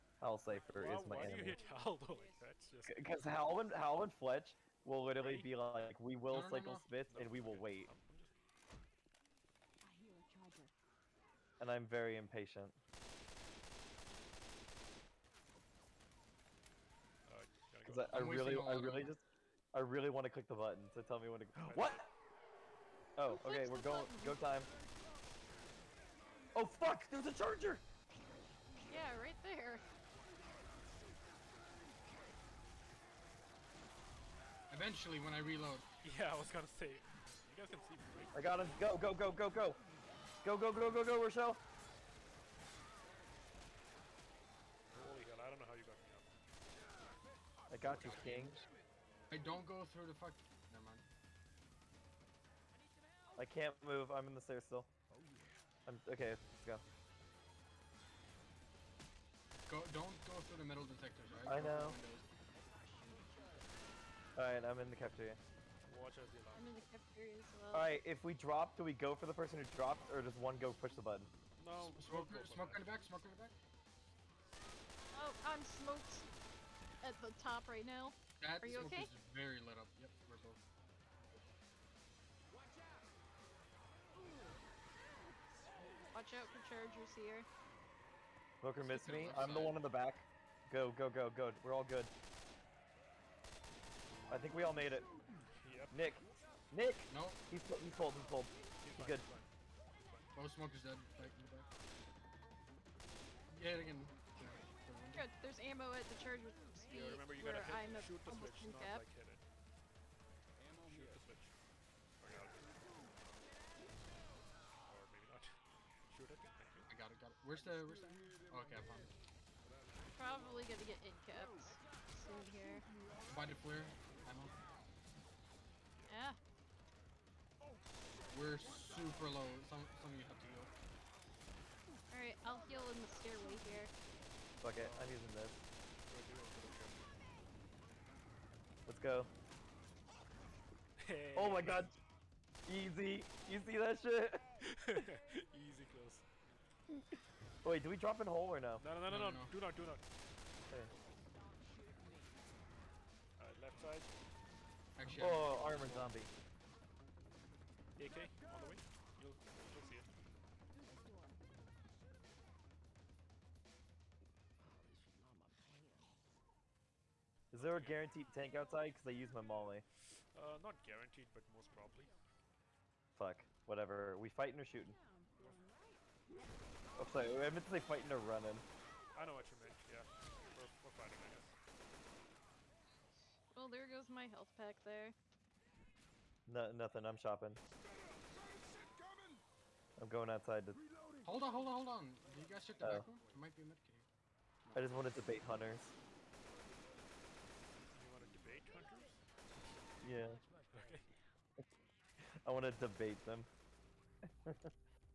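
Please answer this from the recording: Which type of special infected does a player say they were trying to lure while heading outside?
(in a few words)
hunters.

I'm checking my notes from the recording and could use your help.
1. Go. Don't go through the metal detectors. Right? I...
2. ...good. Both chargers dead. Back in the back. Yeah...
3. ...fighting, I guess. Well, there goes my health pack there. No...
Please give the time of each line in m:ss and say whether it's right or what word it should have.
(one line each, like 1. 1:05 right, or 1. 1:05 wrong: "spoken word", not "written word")
1. 0:59 right
2. 1:39 wrong: "smokers", not "chargers"
3. 3:00 right.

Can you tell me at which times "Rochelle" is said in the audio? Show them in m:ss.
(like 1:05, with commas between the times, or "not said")
0:41.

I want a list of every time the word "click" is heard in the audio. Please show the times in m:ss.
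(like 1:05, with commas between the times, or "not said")
0:20.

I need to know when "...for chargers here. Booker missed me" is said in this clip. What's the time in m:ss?
1:26.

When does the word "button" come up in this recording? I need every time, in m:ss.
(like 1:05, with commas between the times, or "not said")
0:20, 1:11.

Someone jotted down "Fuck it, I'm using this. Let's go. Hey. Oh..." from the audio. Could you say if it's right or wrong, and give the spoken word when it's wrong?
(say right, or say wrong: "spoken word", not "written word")
right.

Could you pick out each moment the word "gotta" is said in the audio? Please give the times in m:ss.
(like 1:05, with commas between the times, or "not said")
0:17, 1:47.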